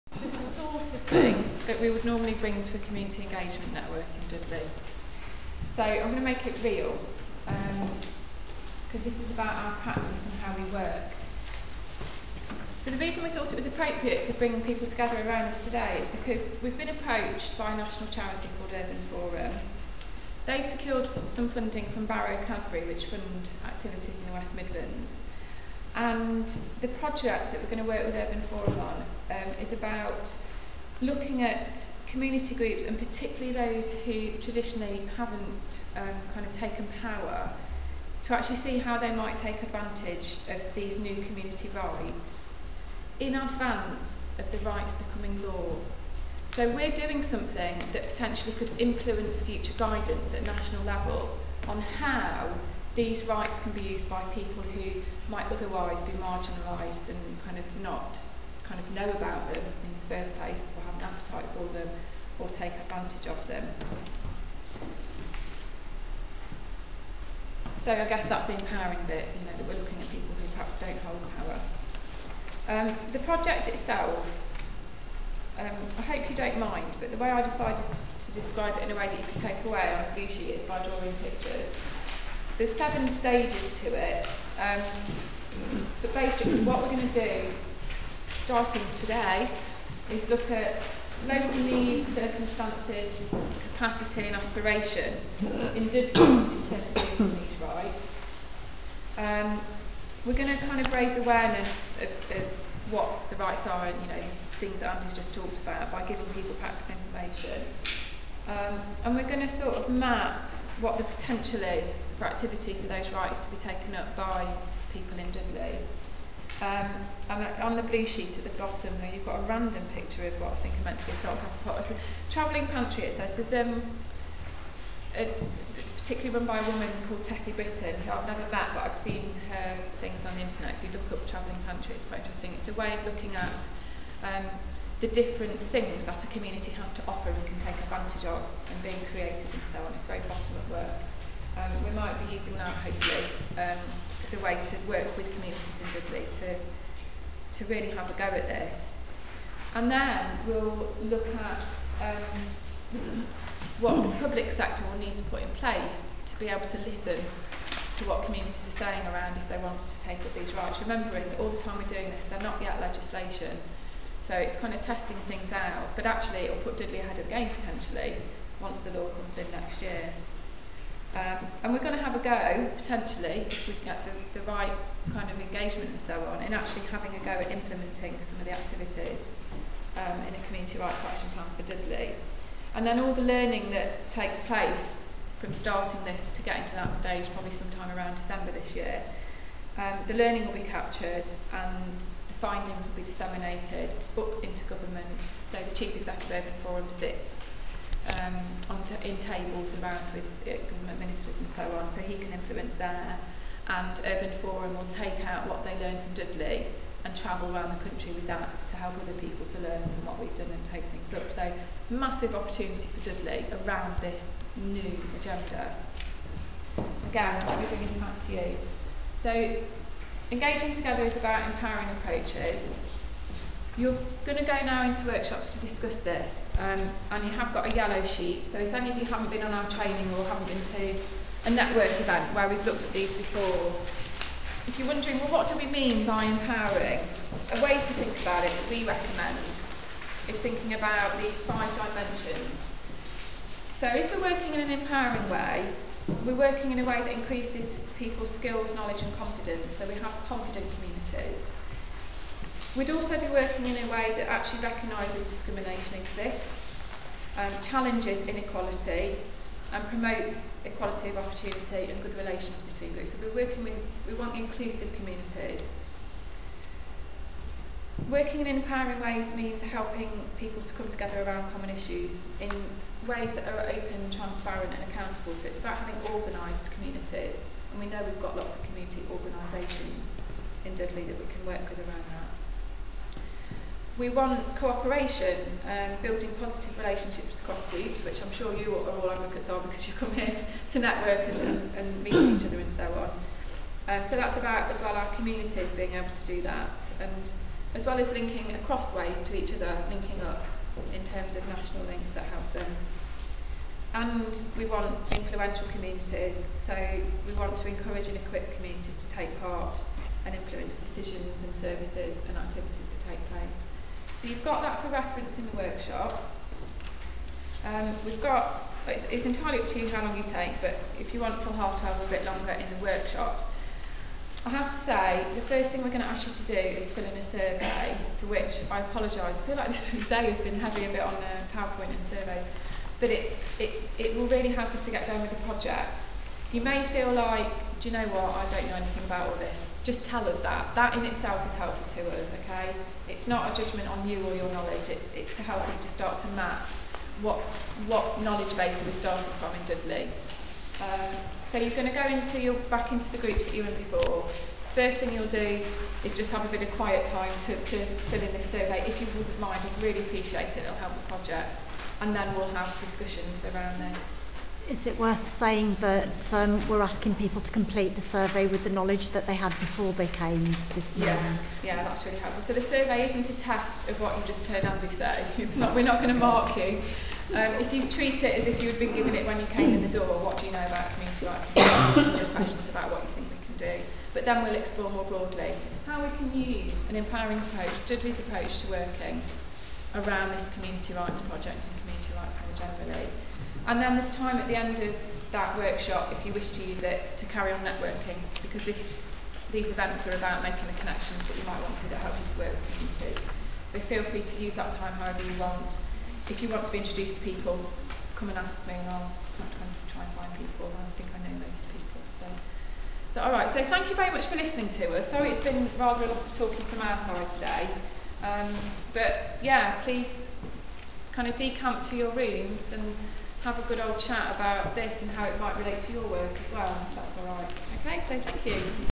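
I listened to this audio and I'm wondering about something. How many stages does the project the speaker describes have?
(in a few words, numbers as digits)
7.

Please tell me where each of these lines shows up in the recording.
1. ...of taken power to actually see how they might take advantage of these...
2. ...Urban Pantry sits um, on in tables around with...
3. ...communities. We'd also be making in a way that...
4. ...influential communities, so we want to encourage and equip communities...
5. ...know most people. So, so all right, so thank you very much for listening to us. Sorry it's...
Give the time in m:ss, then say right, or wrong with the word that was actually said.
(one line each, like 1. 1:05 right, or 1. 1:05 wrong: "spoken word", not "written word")
1. 0:36 right
2. 3:16 wrong: "Forum", not "Pantry"
3. 4:10 wrong: "working", not "making"
4. 5:05 right
5. 6:51 right.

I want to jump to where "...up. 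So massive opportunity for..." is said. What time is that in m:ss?
3:31.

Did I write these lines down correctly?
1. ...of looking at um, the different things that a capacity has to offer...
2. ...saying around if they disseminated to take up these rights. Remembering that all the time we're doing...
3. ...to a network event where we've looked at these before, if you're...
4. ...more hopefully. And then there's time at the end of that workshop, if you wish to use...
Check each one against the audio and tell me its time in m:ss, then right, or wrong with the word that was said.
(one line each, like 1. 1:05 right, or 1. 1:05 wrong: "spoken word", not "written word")
1. 2:12 wrong: "community", not "capacity"
2. 2:38 wrong: "wanted", not "disseminated"
3. 3:50 right
4. 6:32 wrong: "generally", not "hopefully".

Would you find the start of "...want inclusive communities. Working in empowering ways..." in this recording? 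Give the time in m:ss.
4:24.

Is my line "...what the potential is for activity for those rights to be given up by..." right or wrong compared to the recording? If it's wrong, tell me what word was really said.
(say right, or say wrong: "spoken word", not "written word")
wrong: "taken", not "given".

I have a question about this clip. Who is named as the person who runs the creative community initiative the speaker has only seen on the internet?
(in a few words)
Tessie Britton.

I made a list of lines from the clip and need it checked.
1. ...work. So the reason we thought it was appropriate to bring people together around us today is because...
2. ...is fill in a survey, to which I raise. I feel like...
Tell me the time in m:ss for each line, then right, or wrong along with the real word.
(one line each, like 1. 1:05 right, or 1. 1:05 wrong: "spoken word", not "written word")
1. 0:10 right
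2. 5:26 wrong: "apologise", not "raise".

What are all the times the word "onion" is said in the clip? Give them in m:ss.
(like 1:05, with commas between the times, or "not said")
not said.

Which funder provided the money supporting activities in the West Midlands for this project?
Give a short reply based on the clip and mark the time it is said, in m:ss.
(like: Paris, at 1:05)
Barrow Cadbury, at 0:22.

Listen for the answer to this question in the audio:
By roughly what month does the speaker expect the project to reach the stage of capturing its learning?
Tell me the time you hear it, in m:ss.
3:08.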